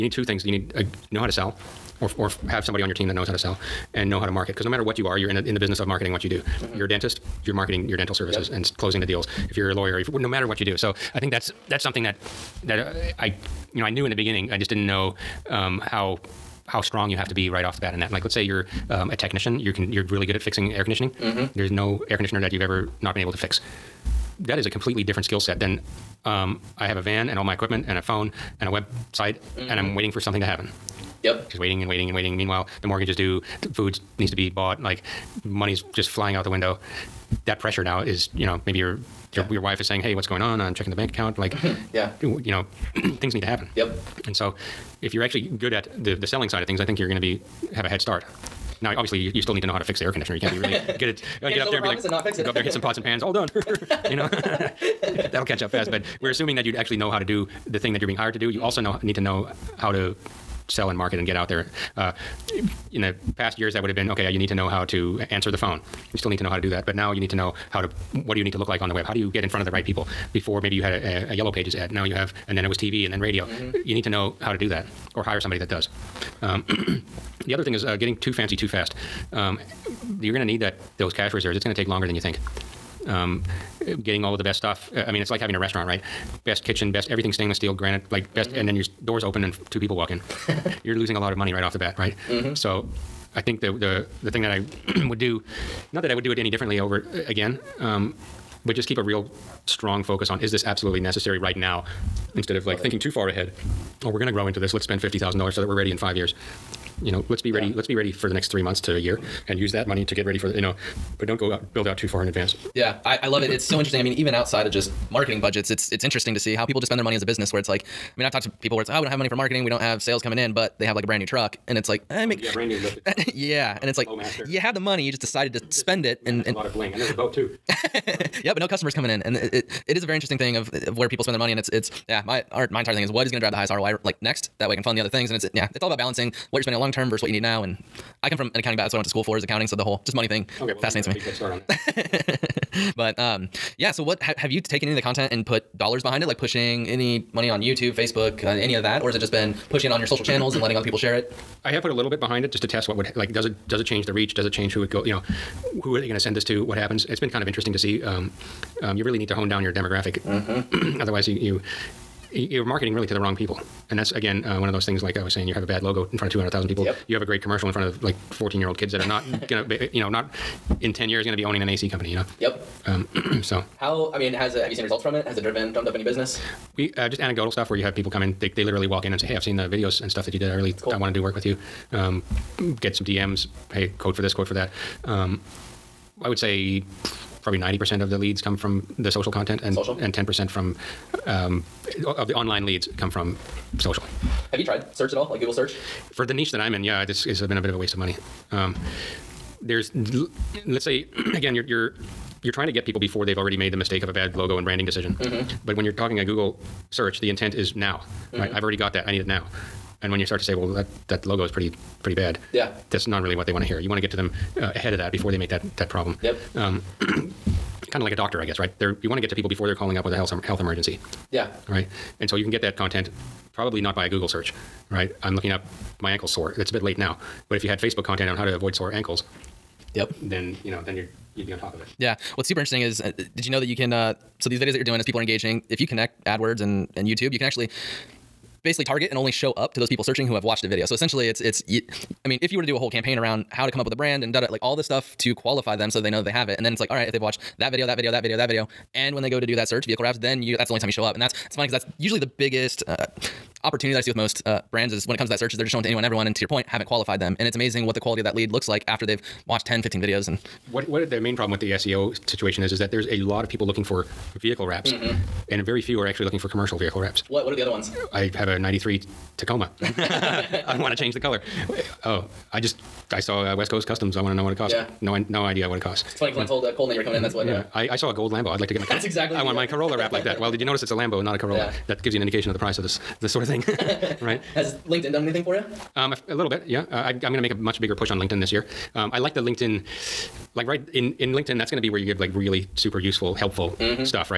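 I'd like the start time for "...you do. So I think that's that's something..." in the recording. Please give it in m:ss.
0:10.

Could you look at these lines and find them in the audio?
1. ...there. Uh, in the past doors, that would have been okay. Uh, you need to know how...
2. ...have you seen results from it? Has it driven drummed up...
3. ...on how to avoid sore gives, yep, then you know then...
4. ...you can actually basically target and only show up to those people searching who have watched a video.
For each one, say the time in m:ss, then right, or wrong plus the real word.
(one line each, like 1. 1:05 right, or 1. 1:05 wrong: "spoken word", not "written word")
1. 1:01 wrong: "years", not "doors"
2. 2:54 right
3. 3:48 wrong: "ankles", not "gives"
4. 3:57 right.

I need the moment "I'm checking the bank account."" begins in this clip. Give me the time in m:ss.
0:40.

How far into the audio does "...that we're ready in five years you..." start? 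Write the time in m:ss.
1:45.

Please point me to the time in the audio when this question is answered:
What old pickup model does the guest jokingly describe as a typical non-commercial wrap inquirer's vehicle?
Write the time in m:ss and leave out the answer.
4:28.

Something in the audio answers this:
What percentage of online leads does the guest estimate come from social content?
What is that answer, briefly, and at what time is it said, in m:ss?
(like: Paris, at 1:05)
90%, at 3:07.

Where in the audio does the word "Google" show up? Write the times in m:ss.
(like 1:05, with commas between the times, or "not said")
3:15, 3:26, 3:44.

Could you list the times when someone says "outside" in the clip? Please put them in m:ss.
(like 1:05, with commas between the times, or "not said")
1:54.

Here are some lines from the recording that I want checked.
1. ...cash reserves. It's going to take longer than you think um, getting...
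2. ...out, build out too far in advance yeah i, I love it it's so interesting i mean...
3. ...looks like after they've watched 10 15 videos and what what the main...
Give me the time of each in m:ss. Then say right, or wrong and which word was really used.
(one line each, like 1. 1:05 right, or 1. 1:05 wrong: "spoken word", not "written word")
1. 1:21 right
2. 1:51 right
3. 4:18 right.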